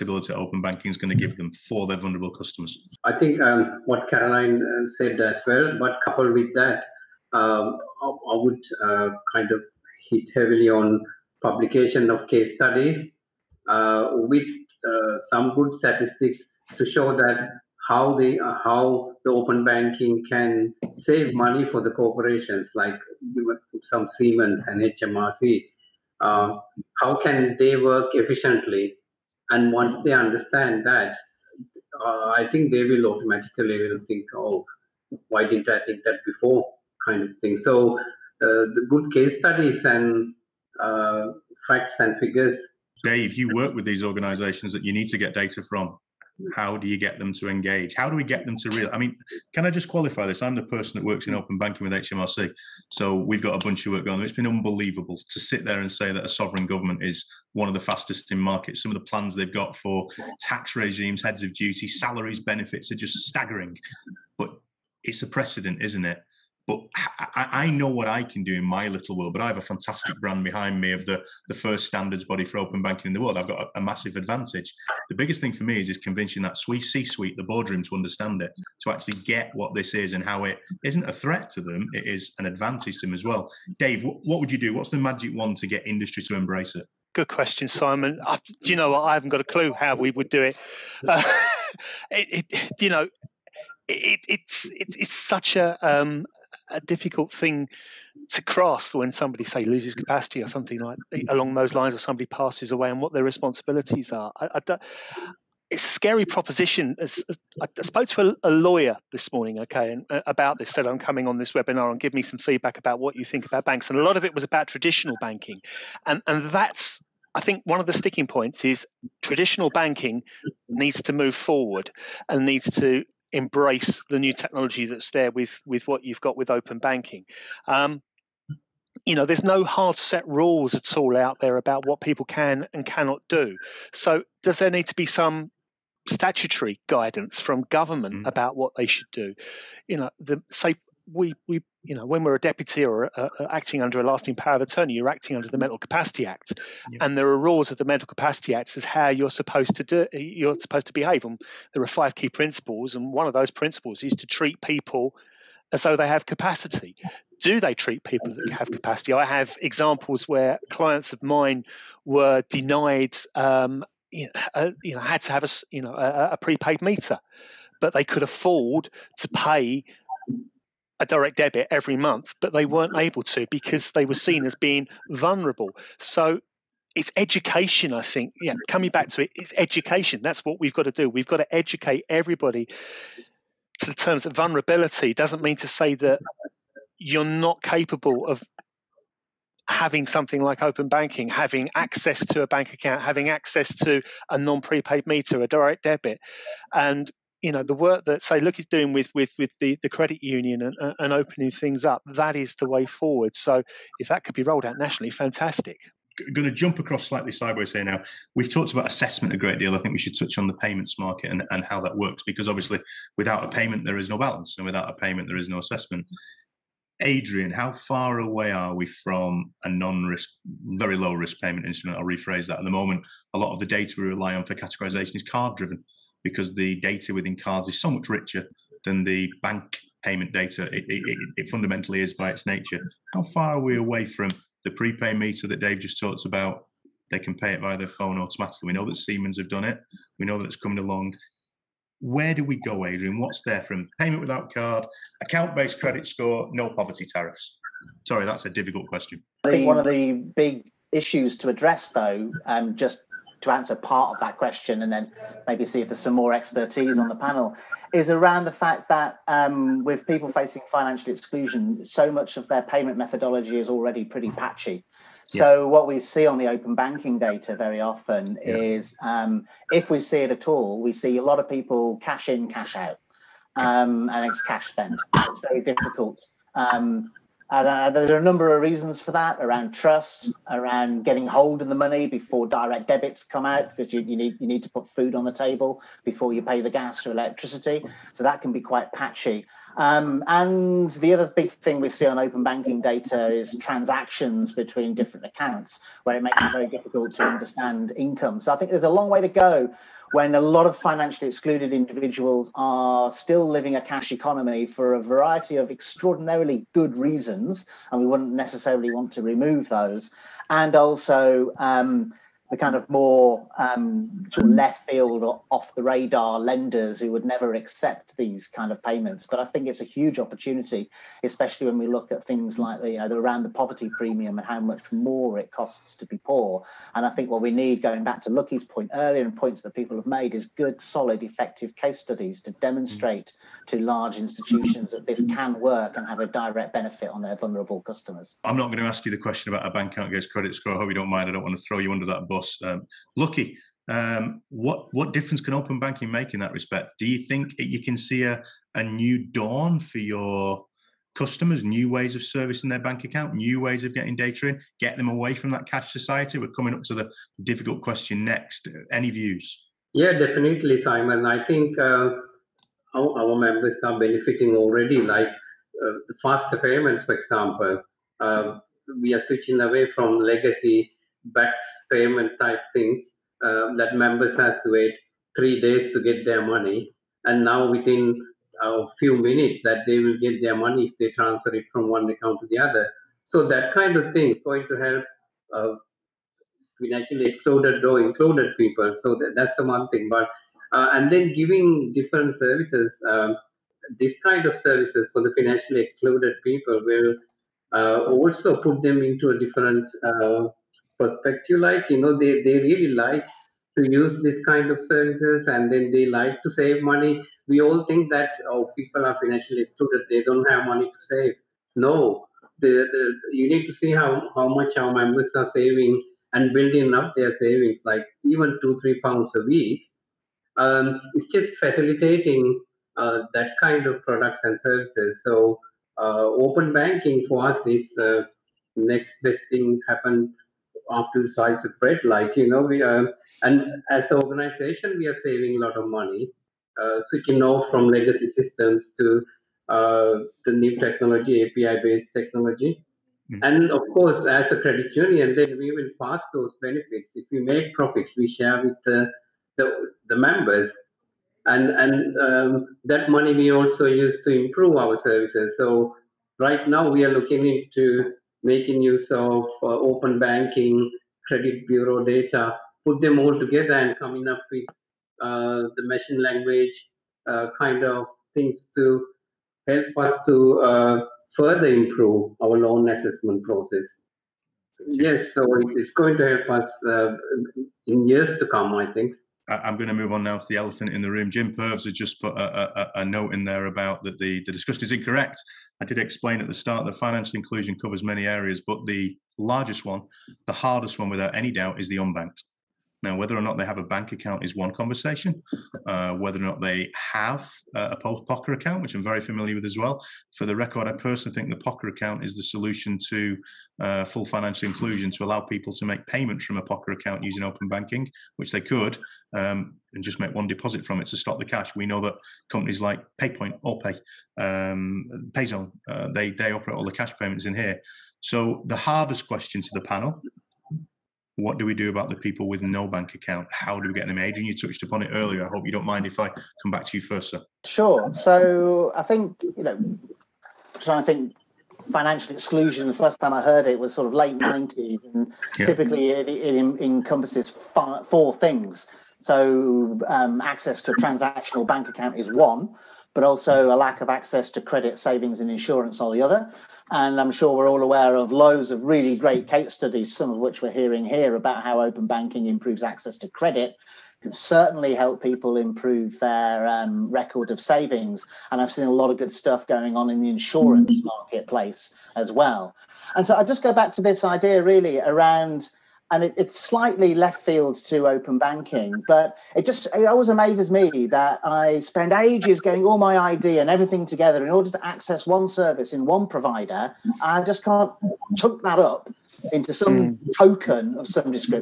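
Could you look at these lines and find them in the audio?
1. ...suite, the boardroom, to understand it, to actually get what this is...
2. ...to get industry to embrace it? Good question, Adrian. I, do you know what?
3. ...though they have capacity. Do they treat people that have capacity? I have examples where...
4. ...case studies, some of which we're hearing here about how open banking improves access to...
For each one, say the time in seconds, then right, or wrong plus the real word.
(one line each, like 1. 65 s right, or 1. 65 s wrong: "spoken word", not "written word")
1. 77 s right
2. 85 s wrong: "Simon", not "Adrian"
3. 155 s right
4. 549 s right.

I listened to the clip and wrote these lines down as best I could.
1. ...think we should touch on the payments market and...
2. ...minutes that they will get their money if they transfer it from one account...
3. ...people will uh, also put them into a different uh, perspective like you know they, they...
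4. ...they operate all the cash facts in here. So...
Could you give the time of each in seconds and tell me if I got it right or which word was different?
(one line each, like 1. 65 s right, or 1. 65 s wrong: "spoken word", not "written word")
1. 209 s right
2. 379 s right
3. 396 s right
4. 516 s wrong: "payments", not "facts".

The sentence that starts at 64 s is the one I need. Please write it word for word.
But it's a precedent, isn't it?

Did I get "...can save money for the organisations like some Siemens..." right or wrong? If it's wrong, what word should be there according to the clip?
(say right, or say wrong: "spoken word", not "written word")
wrong: "corporations", not "organisations".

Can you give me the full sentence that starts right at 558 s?
And I've seen a lot of good stuff going on in the insurance mm-hmm.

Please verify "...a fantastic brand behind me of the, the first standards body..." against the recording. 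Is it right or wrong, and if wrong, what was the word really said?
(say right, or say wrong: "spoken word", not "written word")
right.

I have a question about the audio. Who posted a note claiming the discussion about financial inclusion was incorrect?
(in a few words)
Jim Purves.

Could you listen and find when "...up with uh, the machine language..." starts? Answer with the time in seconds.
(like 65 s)
464 s.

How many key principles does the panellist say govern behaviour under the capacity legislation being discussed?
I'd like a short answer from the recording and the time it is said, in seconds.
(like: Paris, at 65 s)
5, at 151 s.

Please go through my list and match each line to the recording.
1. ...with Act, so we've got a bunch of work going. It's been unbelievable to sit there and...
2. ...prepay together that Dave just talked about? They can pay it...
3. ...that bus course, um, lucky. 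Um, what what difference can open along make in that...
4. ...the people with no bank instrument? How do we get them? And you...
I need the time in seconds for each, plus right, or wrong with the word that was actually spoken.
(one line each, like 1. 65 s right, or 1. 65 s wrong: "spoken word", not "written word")
1. 51 s wrong: "HMRC", not "Act"
2. 234 s wrong: "meter", not "together"
3. 342 s wrong: "banking", not "along"
4. 522 s wrong: "account", not "instrument".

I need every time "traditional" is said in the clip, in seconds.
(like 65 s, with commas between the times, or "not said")
114 s, 119 s.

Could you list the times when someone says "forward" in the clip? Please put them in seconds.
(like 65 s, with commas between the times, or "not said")
121 s, 202 s.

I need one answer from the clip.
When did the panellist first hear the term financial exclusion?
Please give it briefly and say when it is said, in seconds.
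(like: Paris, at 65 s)
Late 90s, at 534 s.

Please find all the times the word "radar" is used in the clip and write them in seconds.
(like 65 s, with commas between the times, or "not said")
315 s.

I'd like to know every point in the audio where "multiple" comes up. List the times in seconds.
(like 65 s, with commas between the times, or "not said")
not said.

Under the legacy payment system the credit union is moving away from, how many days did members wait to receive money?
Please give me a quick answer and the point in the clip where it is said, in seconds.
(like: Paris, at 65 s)
3, at 375 s.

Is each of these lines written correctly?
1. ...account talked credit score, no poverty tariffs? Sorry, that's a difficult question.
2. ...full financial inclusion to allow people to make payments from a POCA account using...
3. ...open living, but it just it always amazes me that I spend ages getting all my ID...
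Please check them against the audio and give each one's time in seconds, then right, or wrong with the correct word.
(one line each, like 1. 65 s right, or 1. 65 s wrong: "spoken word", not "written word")
1. 245 s wrong: "based", not "talked"
2. 504 s right
3. 568 s wrong: "banking", not "living".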